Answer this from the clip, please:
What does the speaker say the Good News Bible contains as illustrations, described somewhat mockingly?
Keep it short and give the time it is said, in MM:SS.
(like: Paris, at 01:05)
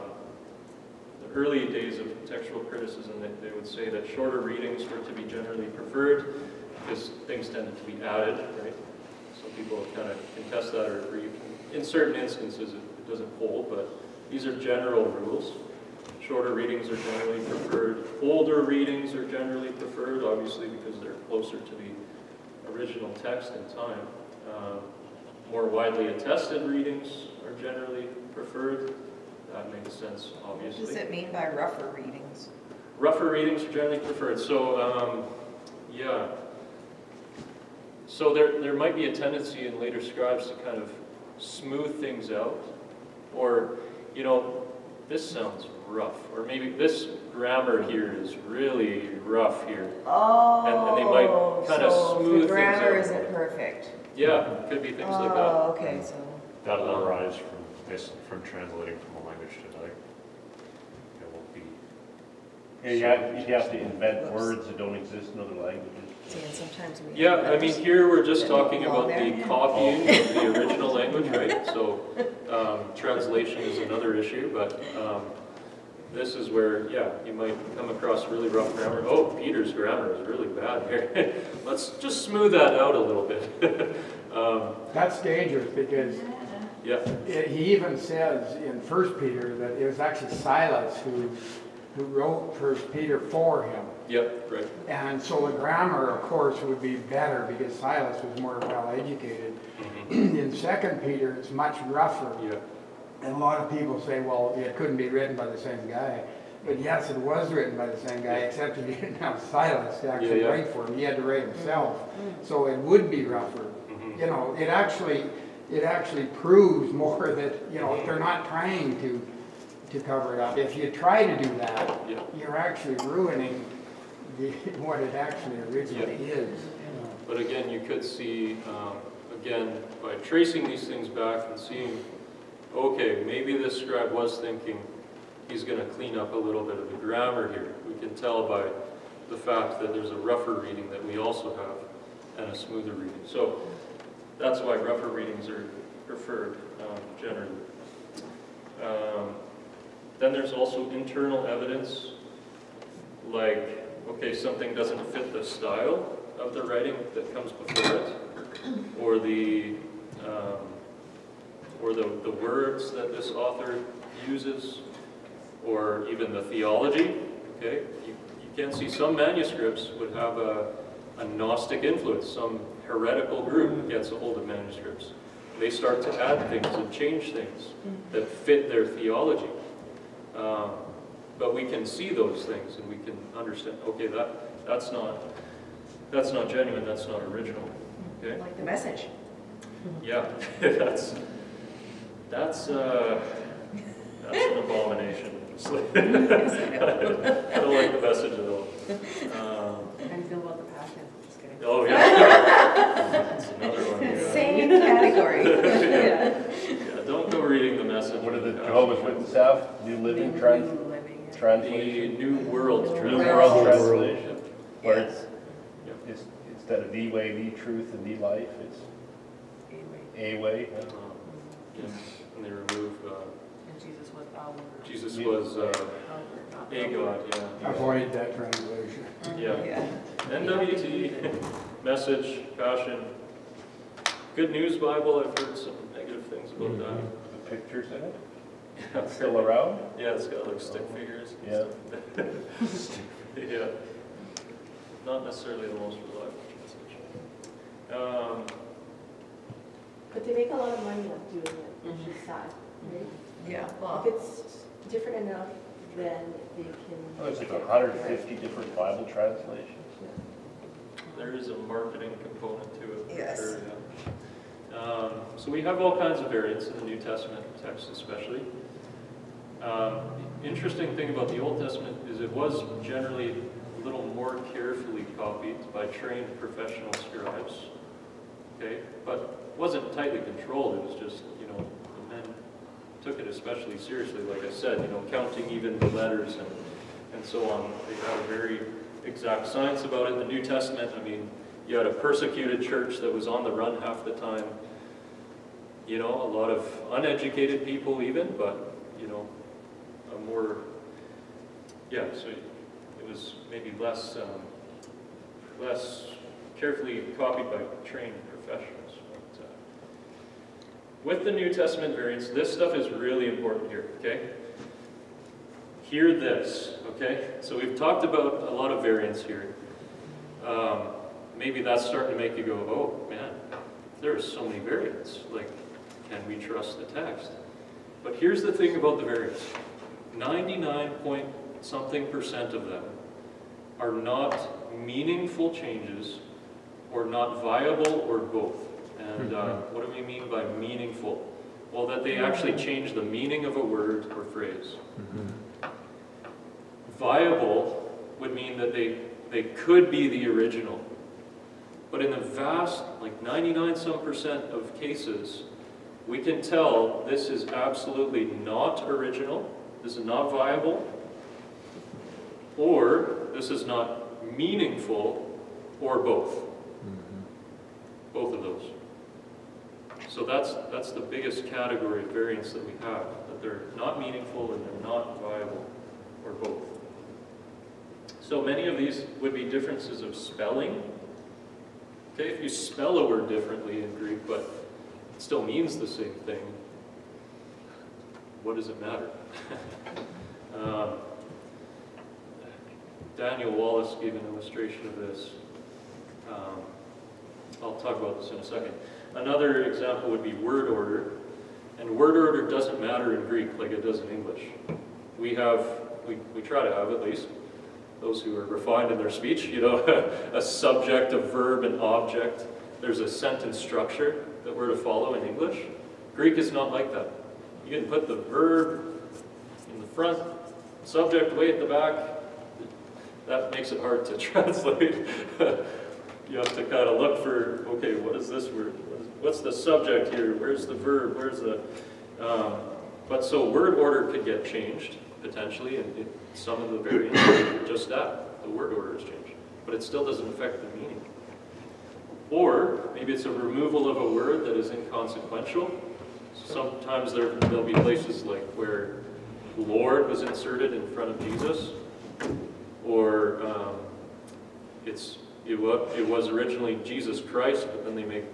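stick figures, at 04:00.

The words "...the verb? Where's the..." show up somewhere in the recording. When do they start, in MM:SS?
07:10.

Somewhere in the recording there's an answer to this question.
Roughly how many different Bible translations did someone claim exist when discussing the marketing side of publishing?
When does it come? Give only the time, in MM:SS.
04:17.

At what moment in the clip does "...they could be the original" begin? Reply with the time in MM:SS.
05:49.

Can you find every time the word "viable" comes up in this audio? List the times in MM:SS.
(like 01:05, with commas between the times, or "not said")
05:37, 05:46, 06:00, 06:15.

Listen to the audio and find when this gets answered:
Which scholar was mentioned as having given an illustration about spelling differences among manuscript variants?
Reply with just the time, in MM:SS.
06:33.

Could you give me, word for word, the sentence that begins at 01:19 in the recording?
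Oh, Peter's grammar is really bad here.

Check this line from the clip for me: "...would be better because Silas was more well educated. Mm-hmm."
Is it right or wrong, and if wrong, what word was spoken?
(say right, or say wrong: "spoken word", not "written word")
right.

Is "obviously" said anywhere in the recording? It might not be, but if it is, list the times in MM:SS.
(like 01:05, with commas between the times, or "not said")
00:20, 00:30.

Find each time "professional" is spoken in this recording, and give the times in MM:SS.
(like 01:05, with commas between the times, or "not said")
04:36, 05:08.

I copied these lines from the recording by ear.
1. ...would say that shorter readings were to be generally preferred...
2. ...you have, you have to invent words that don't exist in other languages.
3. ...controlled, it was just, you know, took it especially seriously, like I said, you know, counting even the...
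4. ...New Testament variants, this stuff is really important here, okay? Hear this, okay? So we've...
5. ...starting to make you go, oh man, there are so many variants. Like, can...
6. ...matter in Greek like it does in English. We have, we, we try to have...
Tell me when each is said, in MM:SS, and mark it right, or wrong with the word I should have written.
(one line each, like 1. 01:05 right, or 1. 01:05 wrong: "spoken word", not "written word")
1. 00:03 right
2. 01:02 right
3. 04:40 right
4. 05:11 right
5. 05:21 right
6. 06:42 right.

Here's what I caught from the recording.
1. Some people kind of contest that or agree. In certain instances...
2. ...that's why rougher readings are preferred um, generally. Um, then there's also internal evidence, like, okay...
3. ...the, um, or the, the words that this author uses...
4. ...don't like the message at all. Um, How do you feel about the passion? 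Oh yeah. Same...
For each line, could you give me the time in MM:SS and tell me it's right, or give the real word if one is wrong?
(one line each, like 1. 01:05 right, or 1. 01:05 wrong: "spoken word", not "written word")
1. 00:09 right
2. 02:24 right
3. 02:39 right
4. 03:15 right.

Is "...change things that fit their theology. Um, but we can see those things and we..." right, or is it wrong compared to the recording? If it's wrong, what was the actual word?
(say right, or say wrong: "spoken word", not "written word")
right.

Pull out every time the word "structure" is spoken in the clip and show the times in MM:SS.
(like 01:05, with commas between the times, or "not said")
06:53.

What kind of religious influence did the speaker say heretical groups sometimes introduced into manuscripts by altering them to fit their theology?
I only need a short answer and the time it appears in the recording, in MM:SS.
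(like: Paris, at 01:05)
Gnostic, at 02:51.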